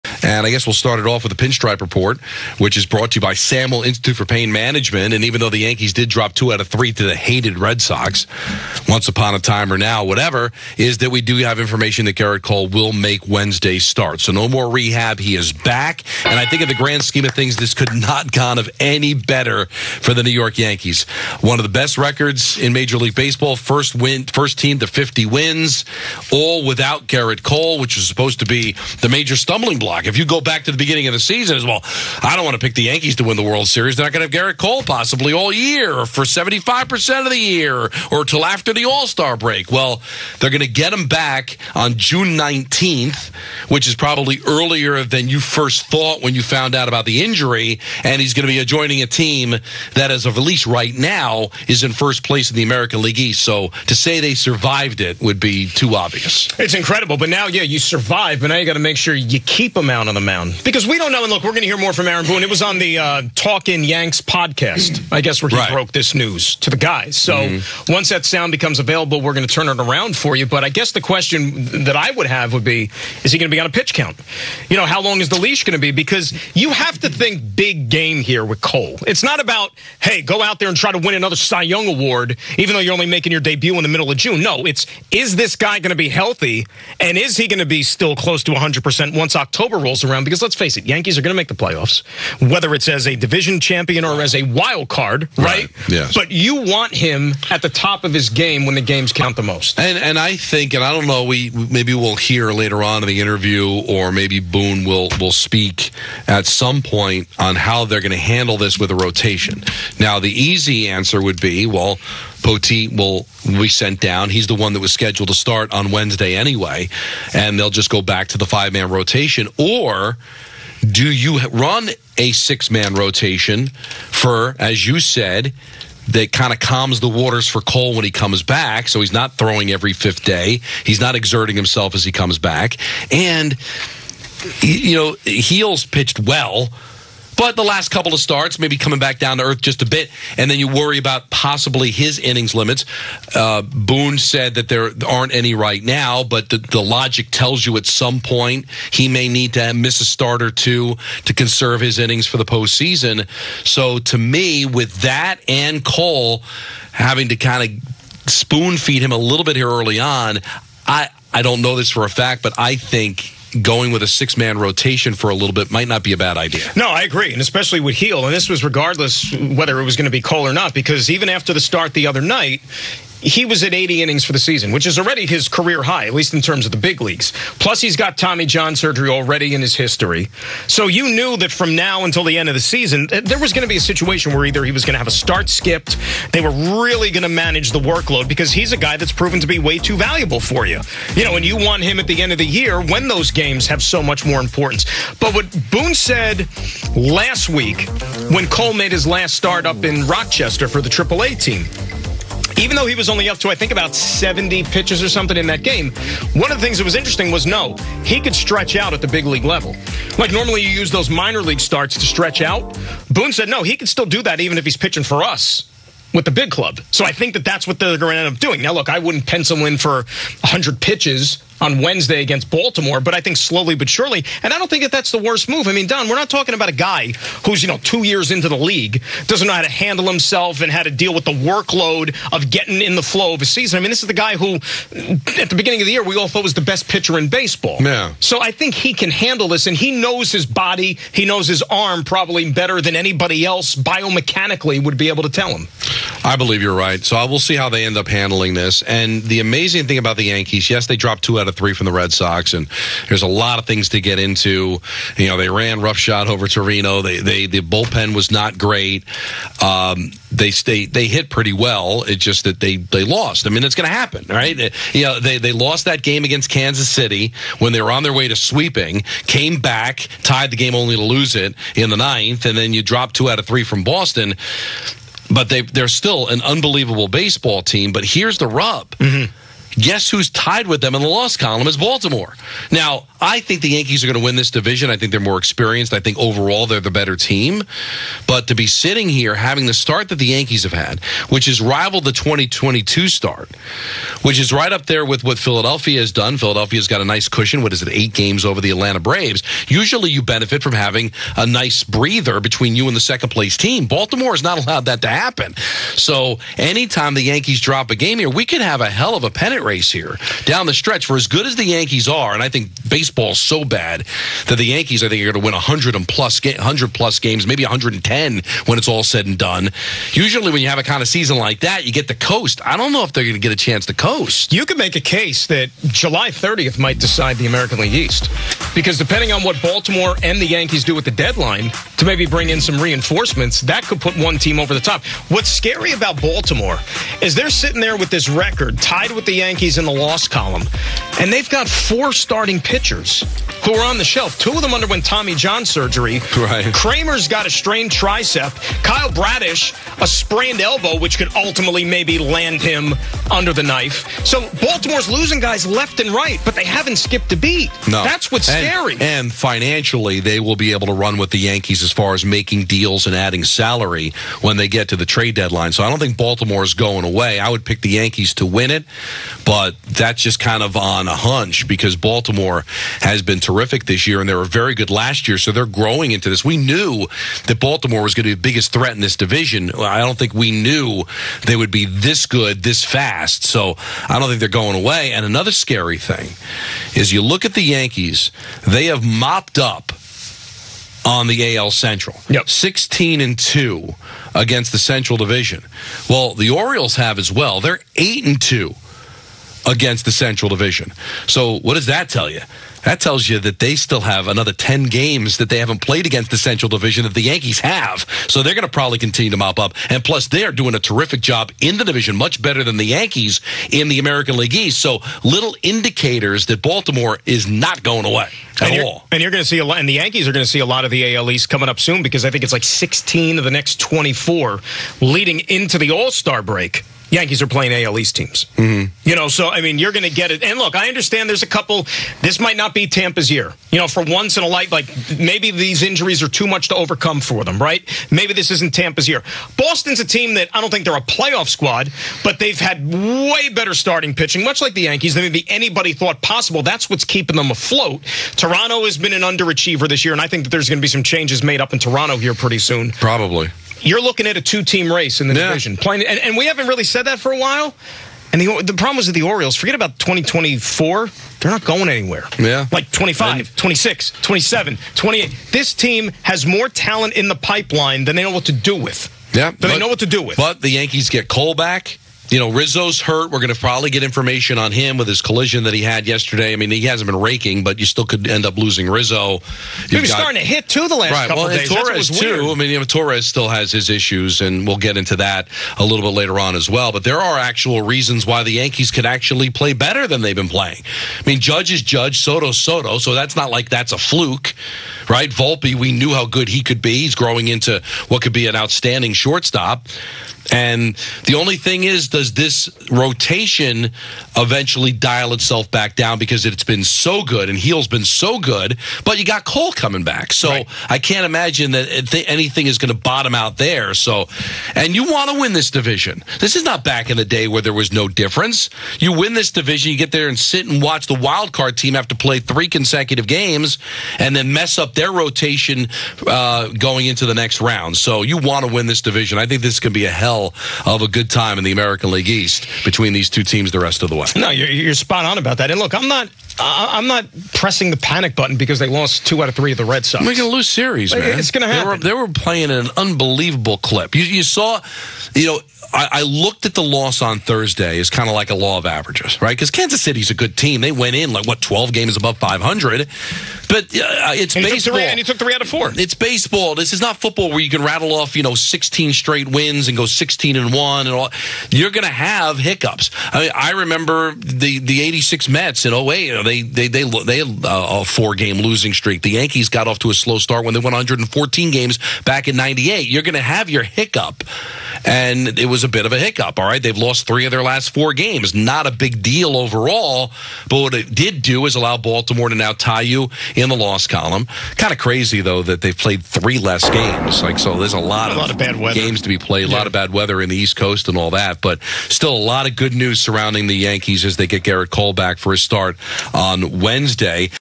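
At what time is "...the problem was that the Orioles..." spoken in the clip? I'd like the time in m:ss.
7:38.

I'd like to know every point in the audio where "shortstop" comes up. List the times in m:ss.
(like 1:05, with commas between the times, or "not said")
8:19.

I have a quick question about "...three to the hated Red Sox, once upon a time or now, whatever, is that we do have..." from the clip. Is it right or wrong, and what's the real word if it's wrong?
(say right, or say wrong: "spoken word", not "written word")
right.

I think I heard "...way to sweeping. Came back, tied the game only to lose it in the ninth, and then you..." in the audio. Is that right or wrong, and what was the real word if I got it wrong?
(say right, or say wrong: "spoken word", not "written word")
right.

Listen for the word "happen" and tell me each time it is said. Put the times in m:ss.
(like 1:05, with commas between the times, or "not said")
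4:23, 5:05, 9:01.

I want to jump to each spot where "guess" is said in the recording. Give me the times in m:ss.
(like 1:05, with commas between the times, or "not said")
0:00, 1:05, 1:10, 4:39.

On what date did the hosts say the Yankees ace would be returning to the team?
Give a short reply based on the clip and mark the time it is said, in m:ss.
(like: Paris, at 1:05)
June 19th, at 0:41.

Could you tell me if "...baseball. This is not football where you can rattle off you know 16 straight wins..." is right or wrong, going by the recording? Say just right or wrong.
right.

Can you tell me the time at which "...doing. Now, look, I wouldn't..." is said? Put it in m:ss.
3:38.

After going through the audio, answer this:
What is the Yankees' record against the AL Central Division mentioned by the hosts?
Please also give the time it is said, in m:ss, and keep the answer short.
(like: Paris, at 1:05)
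16 and 2, at 6:32.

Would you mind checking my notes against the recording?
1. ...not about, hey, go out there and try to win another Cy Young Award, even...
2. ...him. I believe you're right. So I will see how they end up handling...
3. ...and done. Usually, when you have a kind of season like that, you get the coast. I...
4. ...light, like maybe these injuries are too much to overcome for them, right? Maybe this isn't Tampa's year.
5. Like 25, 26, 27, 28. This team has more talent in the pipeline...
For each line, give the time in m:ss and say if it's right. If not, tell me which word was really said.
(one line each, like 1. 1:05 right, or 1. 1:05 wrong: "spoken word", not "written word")
1. 1:19 right
2. 4:05 right
3. 5:19 right
4. 7:14 right
5. 7:42 right.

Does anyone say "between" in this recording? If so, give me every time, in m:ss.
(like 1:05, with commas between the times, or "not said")
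5:02, 8:52.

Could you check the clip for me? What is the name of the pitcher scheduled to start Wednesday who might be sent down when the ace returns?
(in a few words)
Poteet.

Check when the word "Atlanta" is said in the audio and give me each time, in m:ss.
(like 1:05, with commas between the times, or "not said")
4:58.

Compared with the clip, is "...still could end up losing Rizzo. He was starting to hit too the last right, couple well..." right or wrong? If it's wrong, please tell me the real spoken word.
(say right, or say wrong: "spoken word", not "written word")
right.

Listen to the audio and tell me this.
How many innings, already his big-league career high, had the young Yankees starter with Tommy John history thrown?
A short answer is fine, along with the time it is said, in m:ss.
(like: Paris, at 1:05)
80, at 2:53.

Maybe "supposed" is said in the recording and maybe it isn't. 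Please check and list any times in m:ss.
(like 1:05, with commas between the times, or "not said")
0:28.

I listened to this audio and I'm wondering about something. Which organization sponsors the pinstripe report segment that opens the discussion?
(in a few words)
Samuel Institute for Pain Management.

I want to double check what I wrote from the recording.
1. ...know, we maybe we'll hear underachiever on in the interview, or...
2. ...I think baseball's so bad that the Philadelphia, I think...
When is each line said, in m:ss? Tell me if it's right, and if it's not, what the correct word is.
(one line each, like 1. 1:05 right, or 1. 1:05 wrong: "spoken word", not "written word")
1. 1:41 wrong: "later", not "underachiever"
2. 5:12 wrong: "Yankees", not "Philadelphia".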